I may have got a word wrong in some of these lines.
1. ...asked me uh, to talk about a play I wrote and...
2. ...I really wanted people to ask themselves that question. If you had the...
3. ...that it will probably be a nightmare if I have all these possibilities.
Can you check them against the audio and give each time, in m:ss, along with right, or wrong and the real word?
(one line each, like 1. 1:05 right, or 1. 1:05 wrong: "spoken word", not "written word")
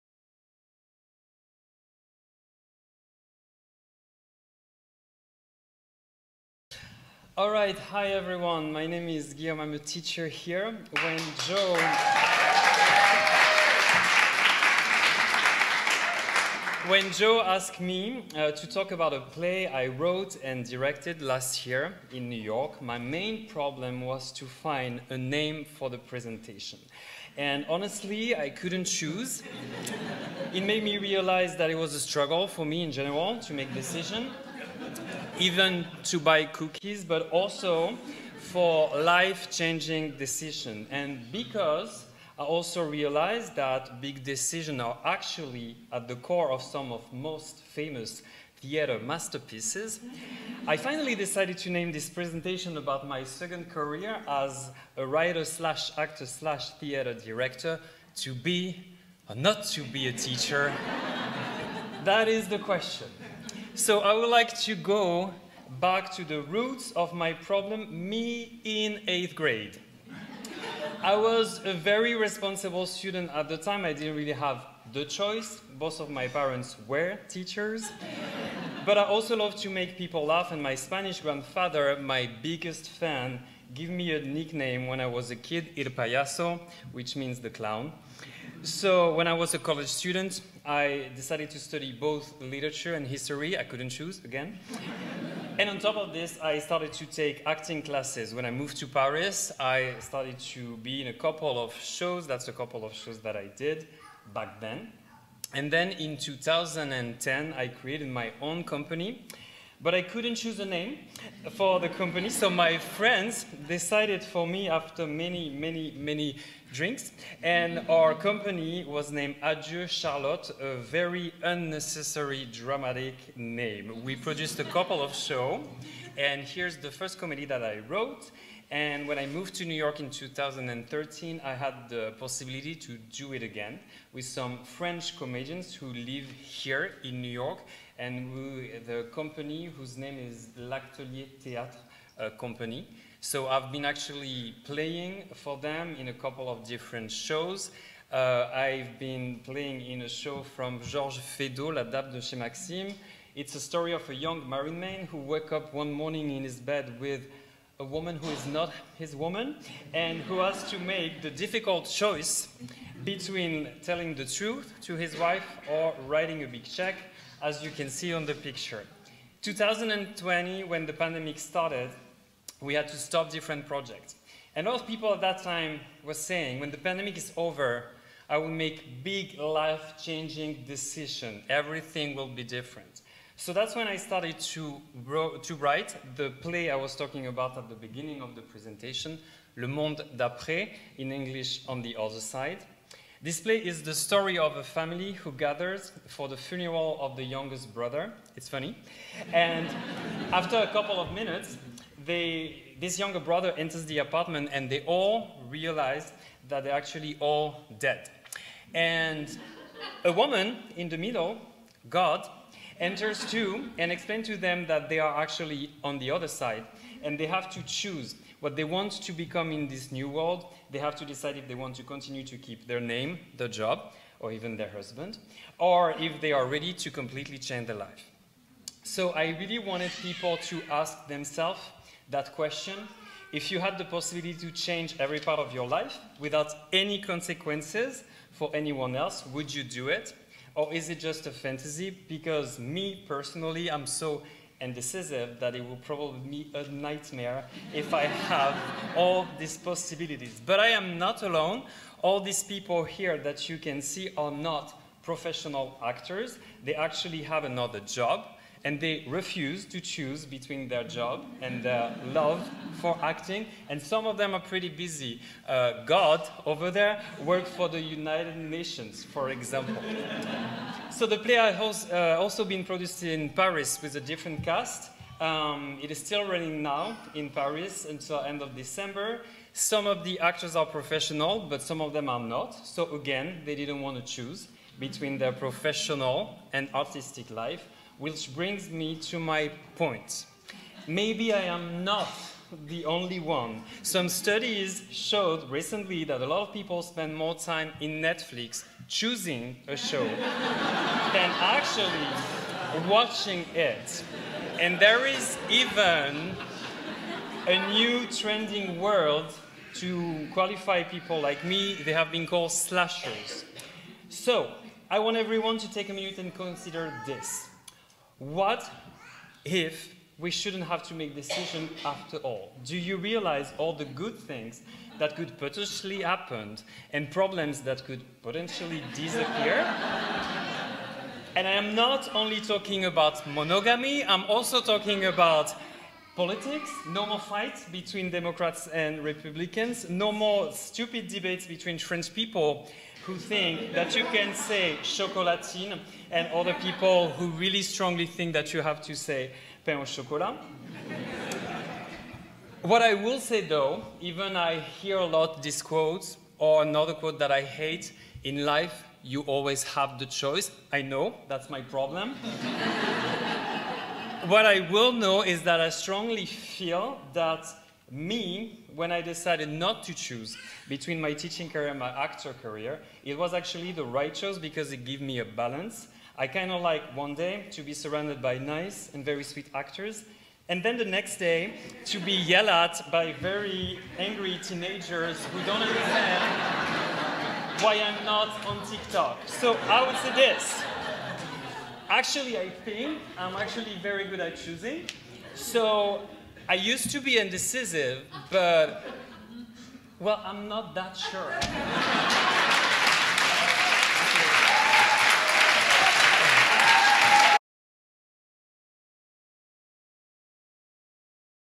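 1. 0:17 right
2. 3:49 right
3. 4:05 right.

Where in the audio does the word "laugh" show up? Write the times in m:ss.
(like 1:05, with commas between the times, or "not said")
1:20.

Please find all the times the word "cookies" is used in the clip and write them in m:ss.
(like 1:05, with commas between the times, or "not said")
0:36.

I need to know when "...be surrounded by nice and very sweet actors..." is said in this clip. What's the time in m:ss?
6:17.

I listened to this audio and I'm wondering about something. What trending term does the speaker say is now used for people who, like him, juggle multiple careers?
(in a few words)
slashers.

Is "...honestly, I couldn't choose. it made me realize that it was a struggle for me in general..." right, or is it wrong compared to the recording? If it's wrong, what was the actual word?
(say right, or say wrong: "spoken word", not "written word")
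right.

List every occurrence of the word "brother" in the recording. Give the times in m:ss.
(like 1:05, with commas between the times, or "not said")
3:17, 3:23.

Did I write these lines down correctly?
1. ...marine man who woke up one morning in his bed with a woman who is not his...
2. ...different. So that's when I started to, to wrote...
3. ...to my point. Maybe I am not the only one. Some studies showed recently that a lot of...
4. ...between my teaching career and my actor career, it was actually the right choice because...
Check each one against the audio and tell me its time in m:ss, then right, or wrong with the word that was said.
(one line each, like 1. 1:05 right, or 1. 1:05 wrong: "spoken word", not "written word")
1. 2:34 right
2. 3:02 wrong: "write", not "wrote"
3. 4:48 right
4. 6:10 right.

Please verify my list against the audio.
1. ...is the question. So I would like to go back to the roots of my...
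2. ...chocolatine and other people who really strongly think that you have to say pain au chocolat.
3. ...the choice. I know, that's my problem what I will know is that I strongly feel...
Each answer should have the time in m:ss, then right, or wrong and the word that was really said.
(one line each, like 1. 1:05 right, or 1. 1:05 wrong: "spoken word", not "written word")
1. 1:02 right
2. 5:44 right
3. 5:59 right.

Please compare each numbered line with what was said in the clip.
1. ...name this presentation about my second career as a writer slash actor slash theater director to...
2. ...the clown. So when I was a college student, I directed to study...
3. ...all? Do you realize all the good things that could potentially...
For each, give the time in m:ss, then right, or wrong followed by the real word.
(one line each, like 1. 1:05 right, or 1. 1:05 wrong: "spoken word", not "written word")
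1. 0:51 right
2. 1:27 wrong: "decided", not "directed"
3. 5:22 right.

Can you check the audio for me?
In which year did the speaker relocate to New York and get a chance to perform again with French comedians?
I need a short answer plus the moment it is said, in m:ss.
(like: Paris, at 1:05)
2013, at 2:10.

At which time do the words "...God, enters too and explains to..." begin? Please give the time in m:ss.
3:31.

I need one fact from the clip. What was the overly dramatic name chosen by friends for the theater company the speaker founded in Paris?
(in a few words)
Adieu Charlotte.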